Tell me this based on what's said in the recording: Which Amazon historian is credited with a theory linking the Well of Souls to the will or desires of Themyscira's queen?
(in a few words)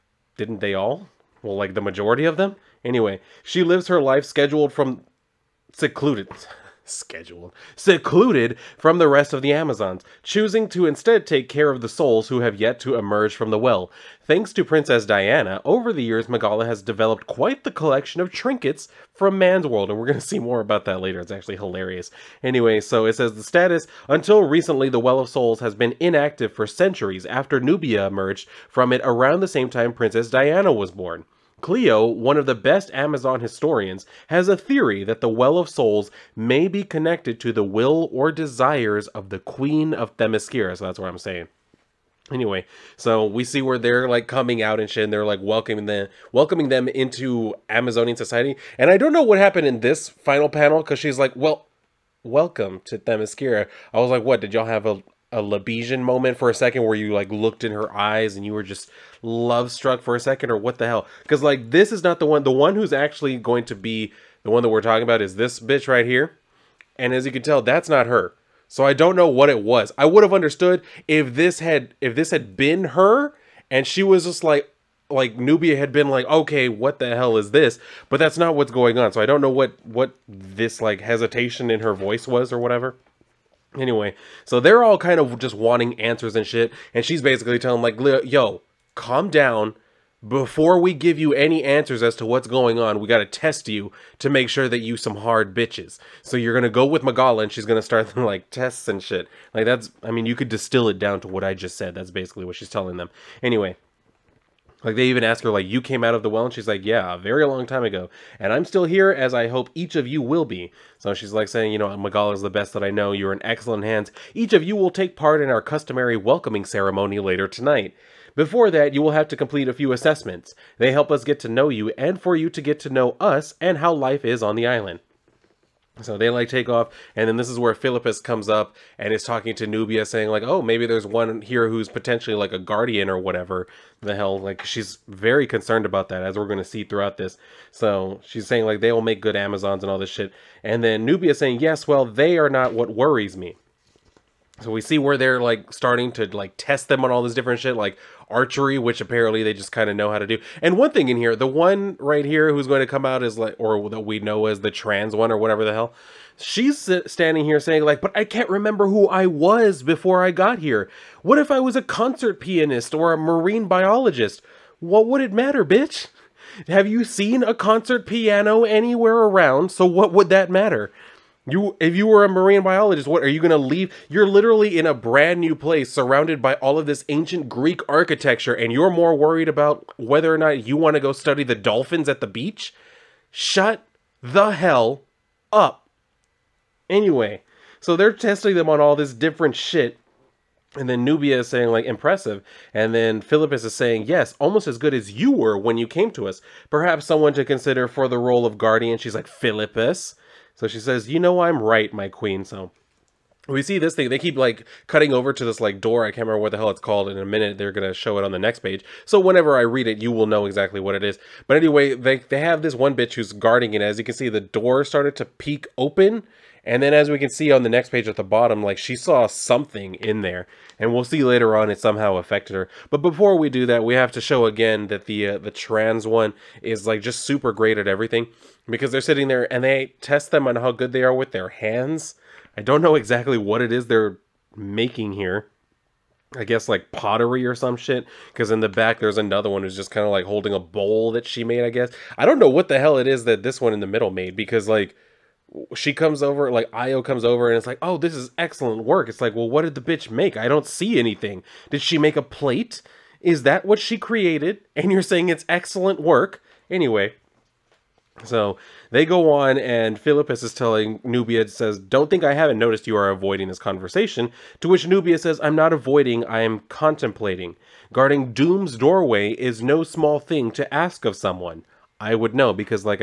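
Cleo.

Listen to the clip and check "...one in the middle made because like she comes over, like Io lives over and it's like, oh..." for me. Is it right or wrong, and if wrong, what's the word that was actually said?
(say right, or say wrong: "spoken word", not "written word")
wrong: "comes", not "lives".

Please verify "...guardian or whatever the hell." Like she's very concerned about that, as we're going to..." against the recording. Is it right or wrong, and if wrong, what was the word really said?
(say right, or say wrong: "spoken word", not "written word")
right.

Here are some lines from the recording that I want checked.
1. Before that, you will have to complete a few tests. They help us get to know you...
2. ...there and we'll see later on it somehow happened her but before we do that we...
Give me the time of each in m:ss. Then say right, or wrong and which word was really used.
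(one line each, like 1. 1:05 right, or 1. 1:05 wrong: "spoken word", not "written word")
1. 1:58 wrong: "assessments", not "tests"
2. 3:40 wrong: "affected", not "happened".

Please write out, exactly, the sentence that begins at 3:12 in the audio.
And then Philippus is saying, yes, almost as good as you were when you came to us.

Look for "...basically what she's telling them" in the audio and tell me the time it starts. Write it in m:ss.
1:42.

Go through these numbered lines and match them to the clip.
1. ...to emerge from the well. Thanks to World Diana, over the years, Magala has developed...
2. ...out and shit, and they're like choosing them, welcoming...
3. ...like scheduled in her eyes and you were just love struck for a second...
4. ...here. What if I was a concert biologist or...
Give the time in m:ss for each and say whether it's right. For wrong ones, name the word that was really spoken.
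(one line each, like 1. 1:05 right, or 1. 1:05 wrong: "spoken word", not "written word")
1. 0:12 wrong: "Princess", not "World"
2. 0:44 wrong: "welcoming", not "choosing"
3. 0:57 wrong: "looked", not "scheduled"
4. 2:40 wrong: "pianist", not "biologist".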